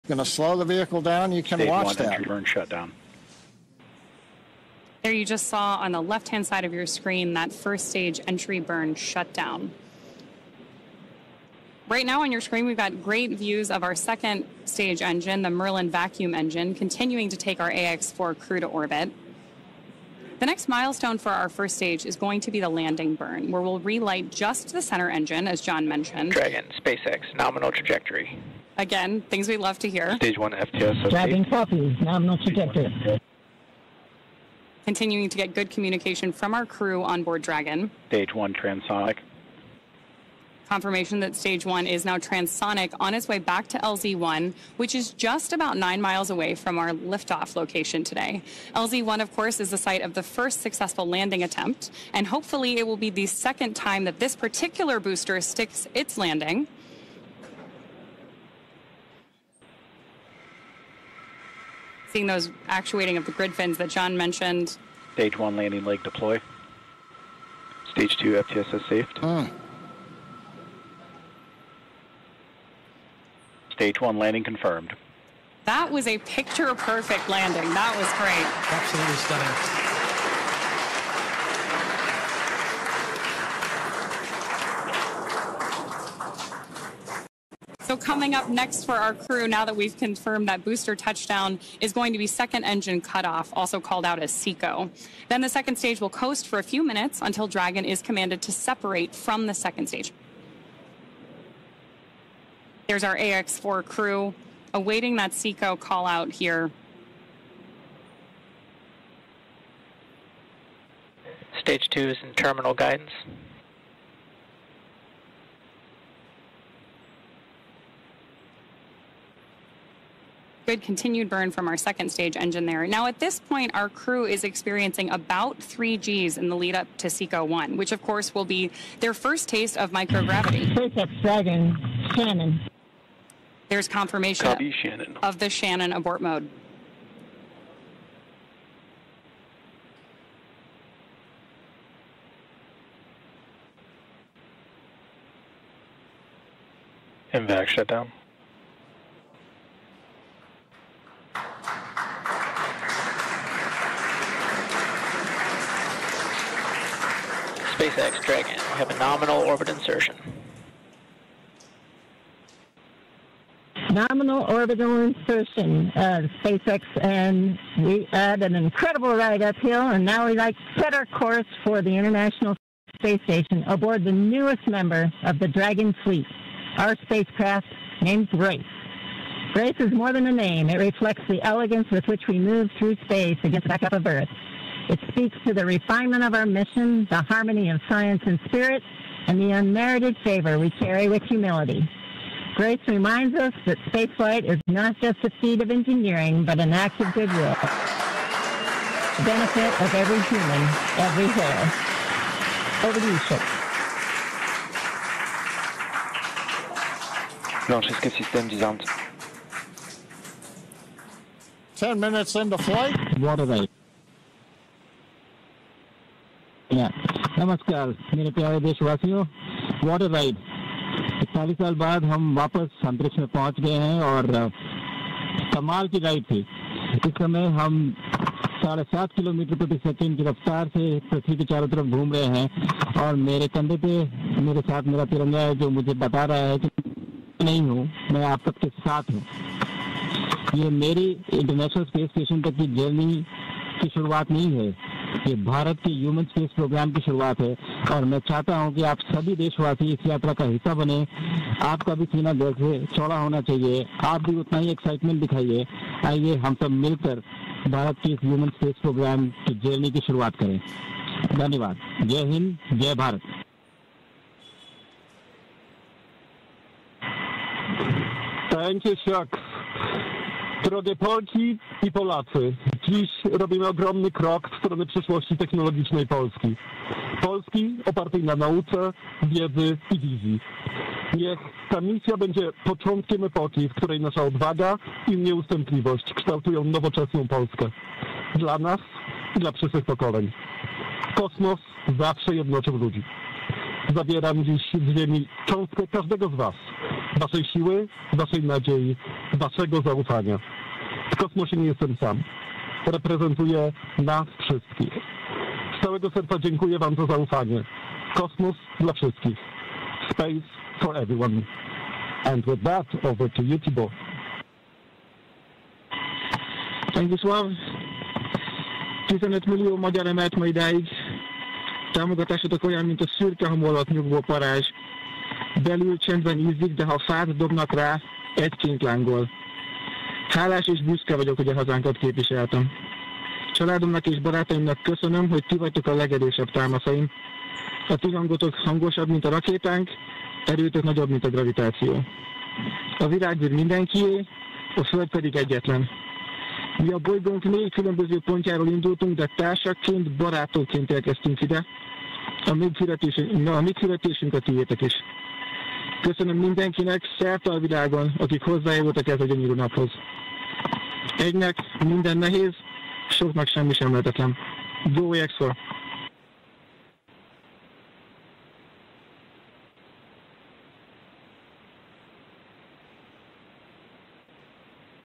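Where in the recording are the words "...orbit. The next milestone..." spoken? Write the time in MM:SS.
00:18.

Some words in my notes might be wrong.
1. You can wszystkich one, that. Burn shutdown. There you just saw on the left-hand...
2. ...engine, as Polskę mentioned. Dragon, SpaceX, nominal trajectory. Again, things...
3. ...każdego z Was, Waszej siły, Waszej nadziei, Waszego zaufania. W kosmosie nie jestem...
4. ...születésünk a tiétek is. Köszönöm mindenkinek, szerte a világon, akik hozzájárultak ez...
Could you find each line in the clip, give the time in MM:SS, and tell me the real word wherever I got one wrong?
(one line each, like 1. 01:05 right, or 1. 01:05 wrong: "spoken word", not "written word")
1. 00:01 wrong: "watch", not "wszystkich"
2. 00:25 wrong: "John", not "Polskę"
3. 04:55 right
4. 05:53 right.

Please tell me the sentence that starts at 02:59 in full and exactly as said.
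Grace is more than a name.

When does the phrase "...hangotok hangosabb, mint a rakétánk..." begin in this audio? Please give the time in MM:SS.
05:38.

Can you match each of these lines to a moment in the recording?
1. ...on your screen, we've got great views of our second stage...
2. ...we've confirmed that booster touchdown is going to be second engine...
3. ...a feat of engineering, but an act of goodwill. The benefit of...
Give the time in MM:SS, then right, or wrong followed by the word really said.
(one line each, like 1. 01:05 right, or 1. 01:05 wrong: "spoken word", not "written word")
1. 00:12 right
2. 01:29 right
3. 03:15 right.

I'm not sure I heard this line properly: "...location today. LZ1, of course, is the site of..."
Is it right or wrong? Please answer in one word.
right.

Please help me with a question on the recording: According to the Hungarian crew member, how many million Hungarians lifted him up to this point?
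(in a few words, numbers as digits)
15 million.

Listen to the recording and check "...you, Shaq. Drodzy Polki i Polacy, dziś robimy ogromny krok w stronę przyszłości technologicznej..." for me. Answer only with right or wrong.
right.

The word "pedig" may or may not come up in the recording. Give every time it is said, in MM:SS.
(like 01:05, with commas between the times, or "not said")
05:45.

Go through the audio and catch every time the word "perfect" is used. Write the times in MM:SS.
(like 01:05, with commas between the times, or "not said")
01:16, 02:10.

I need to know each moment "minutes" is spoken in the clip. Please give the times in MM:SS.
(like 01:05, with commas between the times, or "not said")
01:36, 03:31.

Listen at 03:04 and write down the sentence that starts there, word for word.
It speaks to the refinement of our mission, the harmony of science and spirit, and the unmerited favor we carry with humility.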